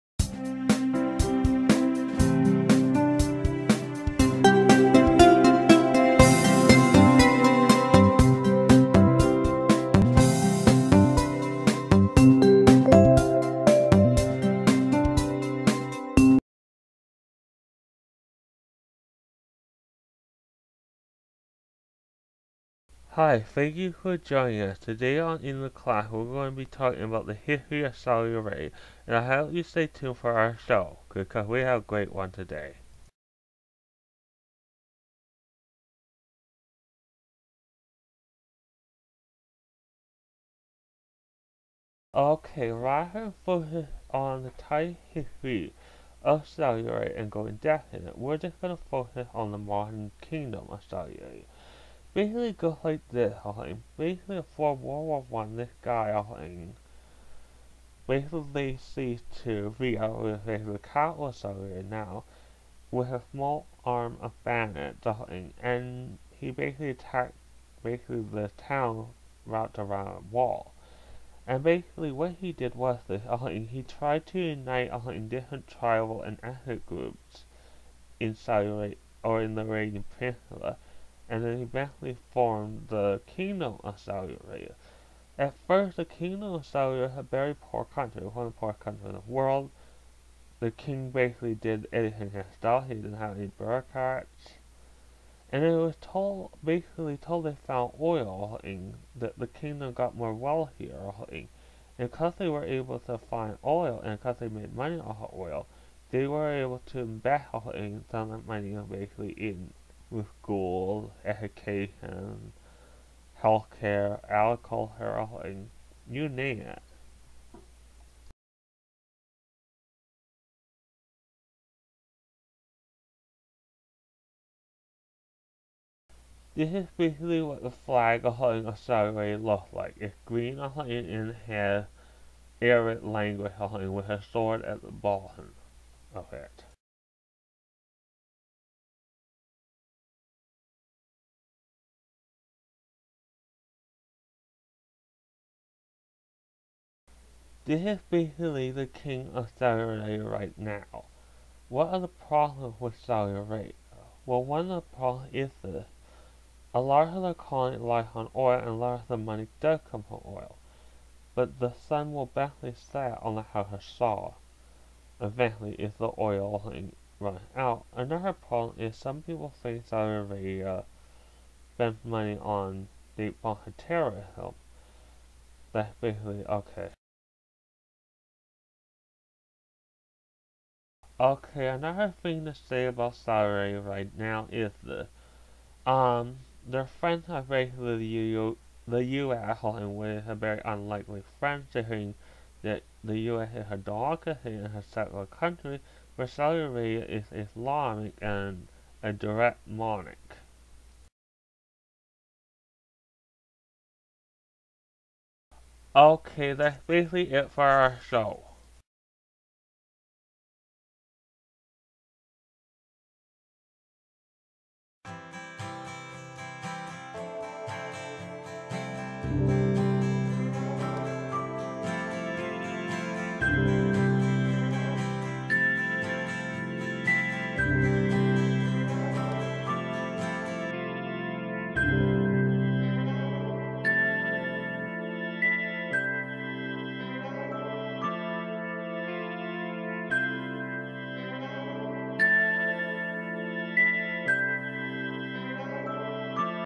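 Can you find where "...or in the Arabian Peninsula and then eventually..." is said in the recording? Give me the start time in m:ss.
1:19.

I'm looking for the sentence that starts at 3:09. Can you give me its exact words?
and we a very unlikely friend saying that the U.S.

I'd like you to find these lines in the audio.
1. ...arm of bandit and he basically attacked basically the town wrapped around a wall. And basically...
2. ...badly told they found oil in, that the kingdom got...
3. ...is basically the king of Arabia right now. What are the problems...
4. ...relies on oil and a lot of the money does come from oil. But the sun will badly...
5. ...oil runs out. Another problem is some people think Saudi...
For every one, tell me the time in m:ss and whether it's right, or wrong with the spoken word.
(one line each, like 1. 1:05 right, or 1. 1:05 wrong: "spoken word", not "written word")
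1. 1:03 right
2. 1:36 wrong: "basically", not "badly"
3. 2:27 right
4. 2:37 right
5. 2:46 right.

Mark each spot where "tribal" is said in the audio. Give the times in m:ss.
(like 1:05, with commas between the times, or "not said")
1:15.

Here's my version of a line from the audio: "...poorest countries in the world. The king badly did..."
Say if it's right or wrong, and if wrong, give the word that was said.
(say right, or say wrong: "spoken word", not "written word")
wrong: "basically", not "badly".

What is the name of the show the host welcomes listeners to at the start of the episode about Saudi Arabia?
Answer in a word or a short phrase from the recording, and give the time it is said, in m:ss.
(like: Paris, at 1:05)
In the Class, at 0:25.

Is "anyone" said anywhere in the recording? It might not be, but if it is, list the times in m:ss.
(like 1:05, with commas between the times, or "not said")
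not said.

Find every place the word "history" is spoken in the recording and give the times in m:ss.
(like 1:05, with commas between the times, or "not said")
0:27, 0:45.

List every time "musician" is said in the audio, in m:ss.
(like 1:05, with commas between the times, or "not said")
not said.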